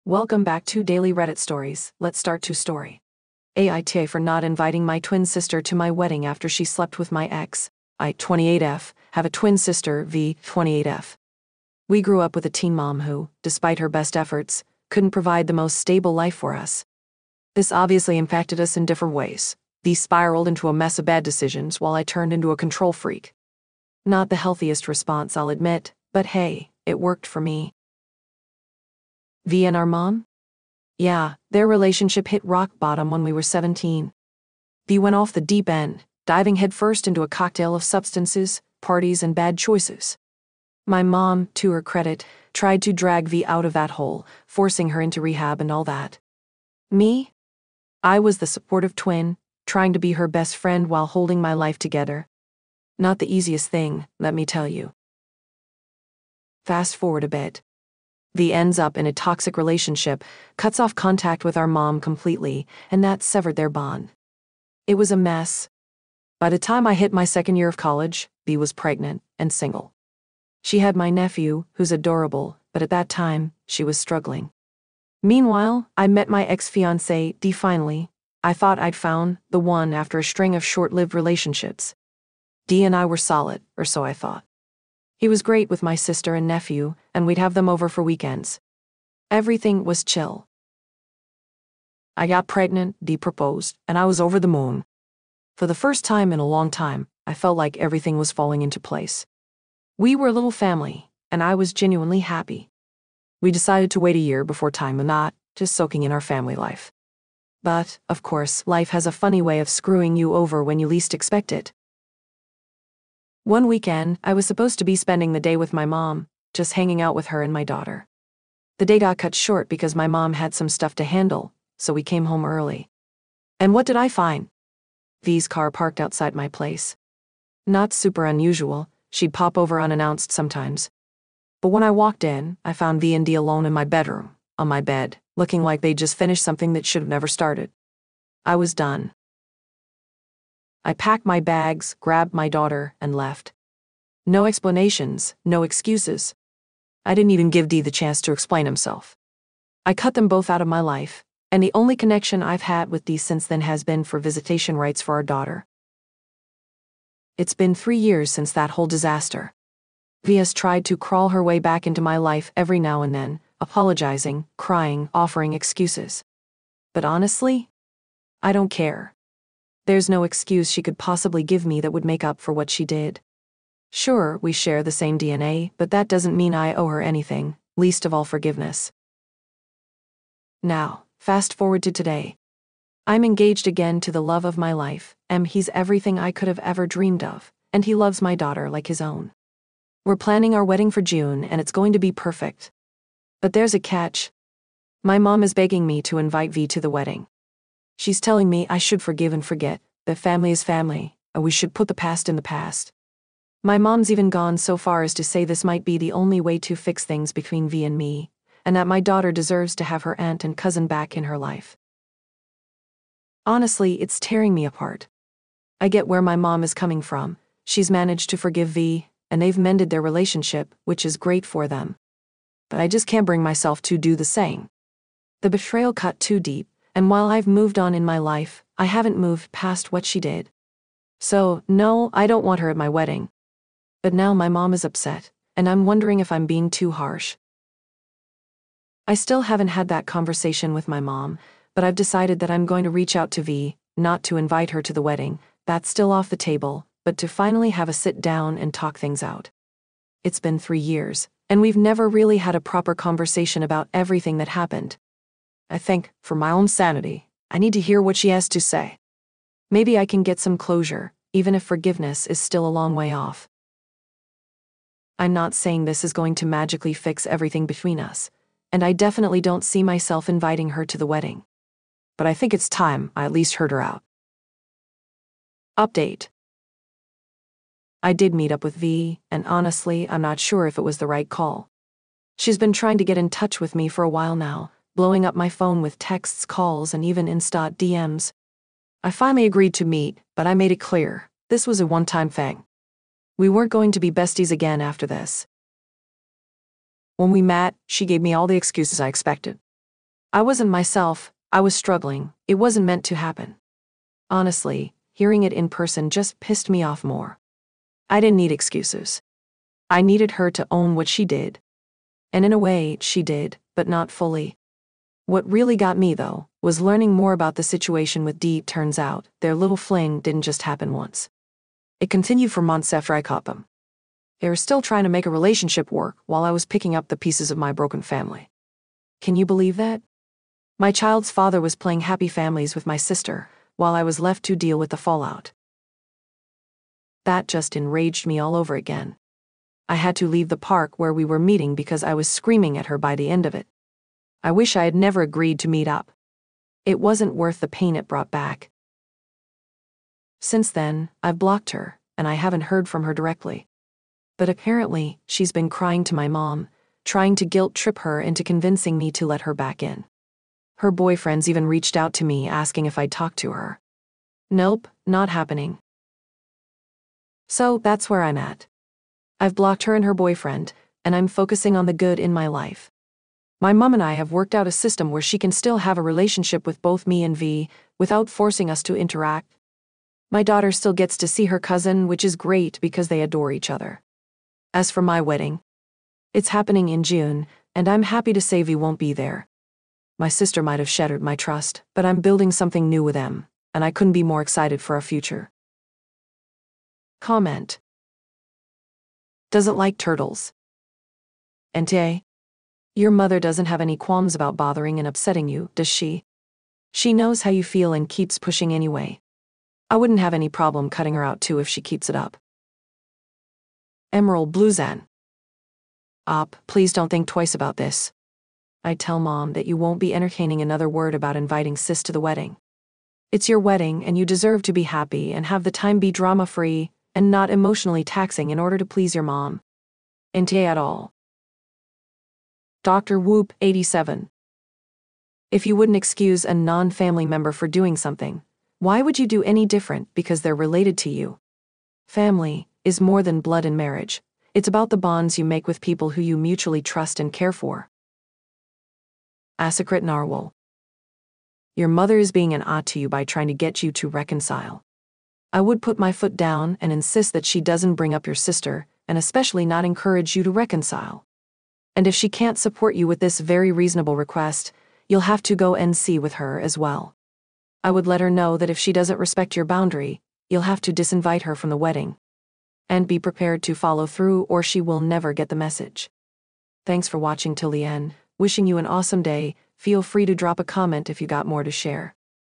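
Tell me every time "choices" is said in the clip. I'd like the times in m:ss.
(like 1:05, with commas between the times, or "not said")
0:39.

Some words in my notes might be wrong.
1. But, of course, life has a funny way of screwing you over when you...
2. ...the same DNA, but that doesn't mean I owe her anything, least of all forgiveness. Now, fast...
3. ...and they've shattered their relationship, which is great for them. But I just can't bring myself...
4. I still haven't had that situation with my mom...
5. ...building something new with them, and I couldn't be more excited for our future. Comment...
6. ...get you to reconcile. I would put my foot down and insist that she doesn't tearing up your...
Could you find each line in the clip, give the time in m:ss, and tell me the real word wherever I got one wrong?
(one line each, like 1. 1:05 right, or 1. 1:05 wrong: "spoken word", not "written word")
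1. 1:47 right
2. 2:54 right
3. 3:39 wrong: "mended", not "shattered"
4. 3:59 wrong: "conversation", not "situation"
5. 6:32 right
6. 7:33 wrong: "bring", not "tearing".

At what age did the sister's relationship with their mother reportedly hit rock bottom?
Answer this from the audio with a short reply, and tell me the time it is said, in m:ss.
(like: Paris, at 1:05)
17, at 0:33.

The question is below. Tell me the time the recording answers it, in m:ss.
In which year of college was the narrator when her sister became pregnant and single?
1:07.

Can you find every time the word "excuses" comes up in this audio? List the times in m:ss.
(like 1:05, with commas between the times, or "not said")
2:25, 2:45, 2:50, 4:58, 5:08, 7:15.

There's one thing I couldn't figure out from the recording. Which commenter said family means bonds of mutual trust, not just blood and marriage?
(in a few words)
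Dr. Whoop, 87.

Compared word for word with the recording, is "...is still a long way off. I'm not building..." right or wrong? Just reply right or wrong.
wrong.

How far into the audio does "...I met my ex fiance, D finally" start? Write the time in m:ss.
1:15.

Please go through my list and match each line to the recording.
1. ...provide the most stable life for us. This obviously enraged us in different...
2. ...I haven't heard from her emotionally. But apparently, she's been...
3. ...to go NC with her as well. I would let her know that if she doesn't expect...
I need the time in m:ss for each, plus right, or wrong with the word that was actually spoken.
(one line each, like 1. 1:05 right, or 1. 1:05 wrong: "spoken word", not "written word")
1. 0:15 wrong: "impacted", not "enraged"
2. 5:52 wrong: "directly", not "emotionally"
3. 7:45 wrong: "respect", not "expect".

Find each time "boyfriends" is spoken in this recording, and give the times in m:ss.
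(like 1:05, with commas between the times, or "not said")
6:00, 6:10.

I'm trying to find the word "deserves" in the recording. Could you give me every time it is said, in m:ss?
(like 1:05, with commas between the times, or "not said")
3:29, 7:04.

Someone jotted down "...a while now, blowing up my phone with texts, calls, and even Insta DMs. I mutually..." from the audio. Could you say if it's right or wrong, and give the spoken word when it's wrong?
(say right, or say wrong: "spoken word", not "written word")
wrong: "finally", not "mutually".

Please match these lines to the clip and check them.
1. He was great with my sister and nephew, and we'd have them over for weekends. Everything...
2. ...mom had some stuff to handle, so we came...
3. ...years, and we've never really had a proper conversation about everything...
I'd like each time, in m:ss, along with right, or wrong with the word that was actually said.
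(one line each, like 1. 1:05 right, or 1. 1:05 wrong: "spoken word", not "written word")
1. 1:25 right
2. 2:00 right
3. 4:10 right.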